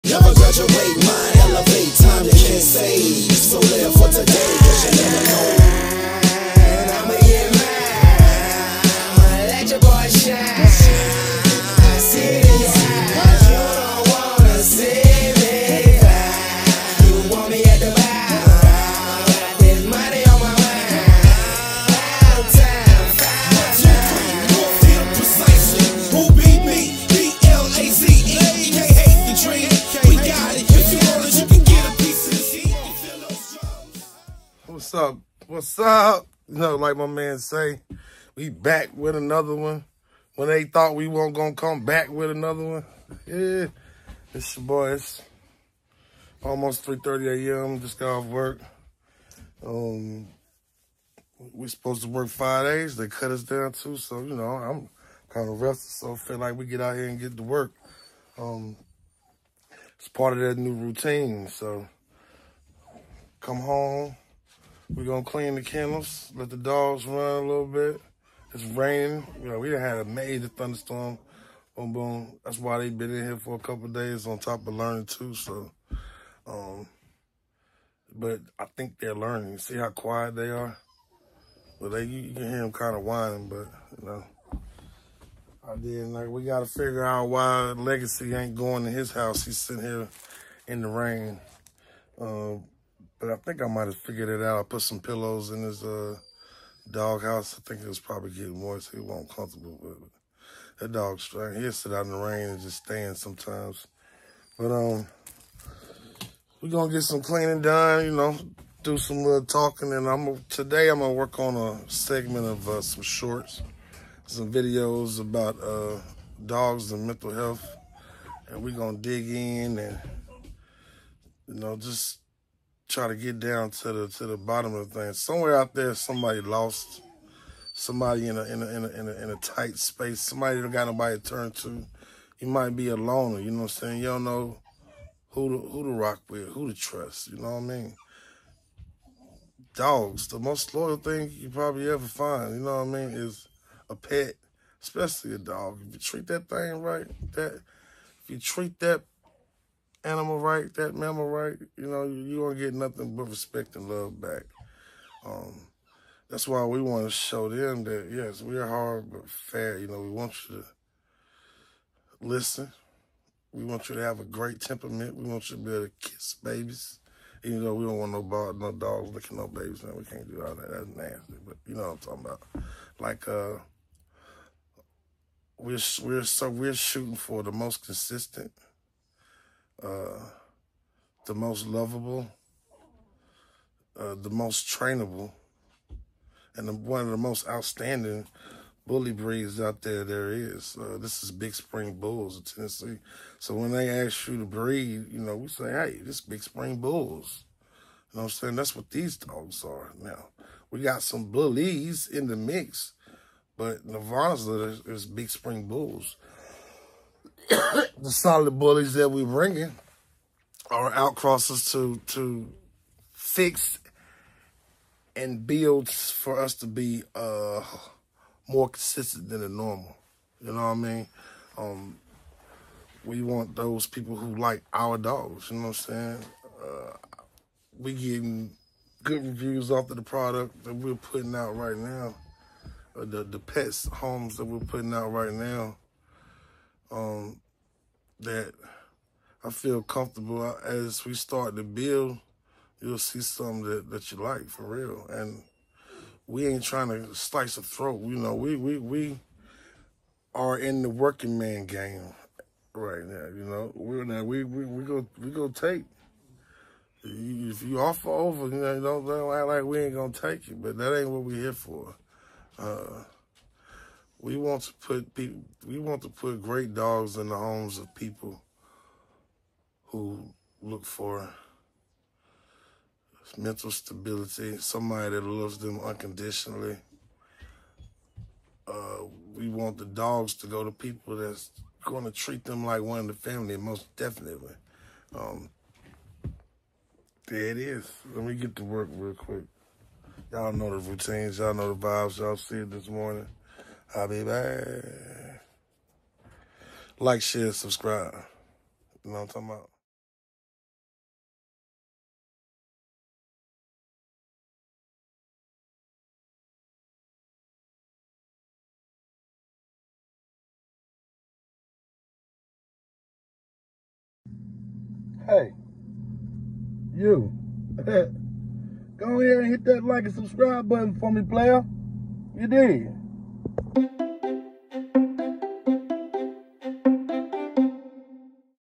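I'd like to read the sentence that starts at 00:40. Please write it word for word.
When they thought we weren't gonna come back with another one.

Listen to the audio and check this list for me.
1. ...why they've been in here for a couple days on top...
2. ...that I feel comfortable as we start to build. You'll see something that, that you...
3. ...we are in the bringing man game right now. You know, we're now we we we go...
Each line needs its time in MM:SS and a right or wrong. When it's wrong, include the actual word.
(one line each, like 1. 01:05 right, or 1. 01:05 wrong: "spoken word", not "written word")
1. 01:12 right
2. 03:58 right
3. 04:08 wrong: "working", not "bringing".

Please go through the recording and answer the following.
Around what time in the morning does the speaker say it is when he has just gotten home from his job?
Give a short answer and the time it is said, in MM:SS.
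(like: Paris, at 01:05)
3:30 a.m., at 00:46.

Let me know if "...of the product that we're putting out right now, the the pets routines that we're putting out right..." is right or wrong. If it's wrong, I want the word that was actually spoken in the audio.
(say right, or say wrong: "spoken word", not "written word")
wrong: "homes", not "routines".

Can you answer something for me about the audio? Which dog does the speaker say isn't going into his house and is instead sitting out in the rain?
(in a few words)
Legacy.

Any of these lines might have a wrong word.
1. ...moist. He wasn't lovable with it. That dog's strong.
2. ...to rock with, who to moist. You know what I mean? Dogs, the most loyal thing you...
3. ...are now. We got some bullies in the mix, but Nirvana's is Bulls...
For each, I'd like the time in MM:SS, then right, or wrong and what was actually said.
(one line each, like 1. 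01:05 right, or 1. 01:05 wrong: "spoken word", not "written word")
1. 01:38 wrong: "comfortable", not "lovable"
2. 02:15 wrong: "trust", not "moist"
3. 03:19 wrong: "Big", not "Bulls".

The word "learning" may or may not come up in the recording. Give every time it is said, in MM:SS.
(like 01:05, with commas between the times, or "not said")
01:14, 01:19.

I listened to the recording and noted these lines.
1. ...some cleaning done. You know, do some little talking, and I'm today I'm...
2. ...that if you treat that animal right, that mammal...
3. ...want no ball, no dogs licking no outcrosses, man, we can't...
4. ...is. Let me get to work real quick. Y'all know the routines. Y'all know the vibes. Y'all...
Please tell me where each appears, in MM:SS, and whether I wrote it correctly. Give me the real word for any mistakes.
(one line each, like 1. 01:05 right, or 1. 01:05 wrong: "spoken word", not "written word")
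1. 01:47 right
2. 02:27 right
3. 02:47 wrong: "babies", not "outcrosses"
4. 04:47 right.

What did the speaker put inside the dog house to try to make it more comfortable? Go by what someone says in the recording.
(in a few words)
Pillows.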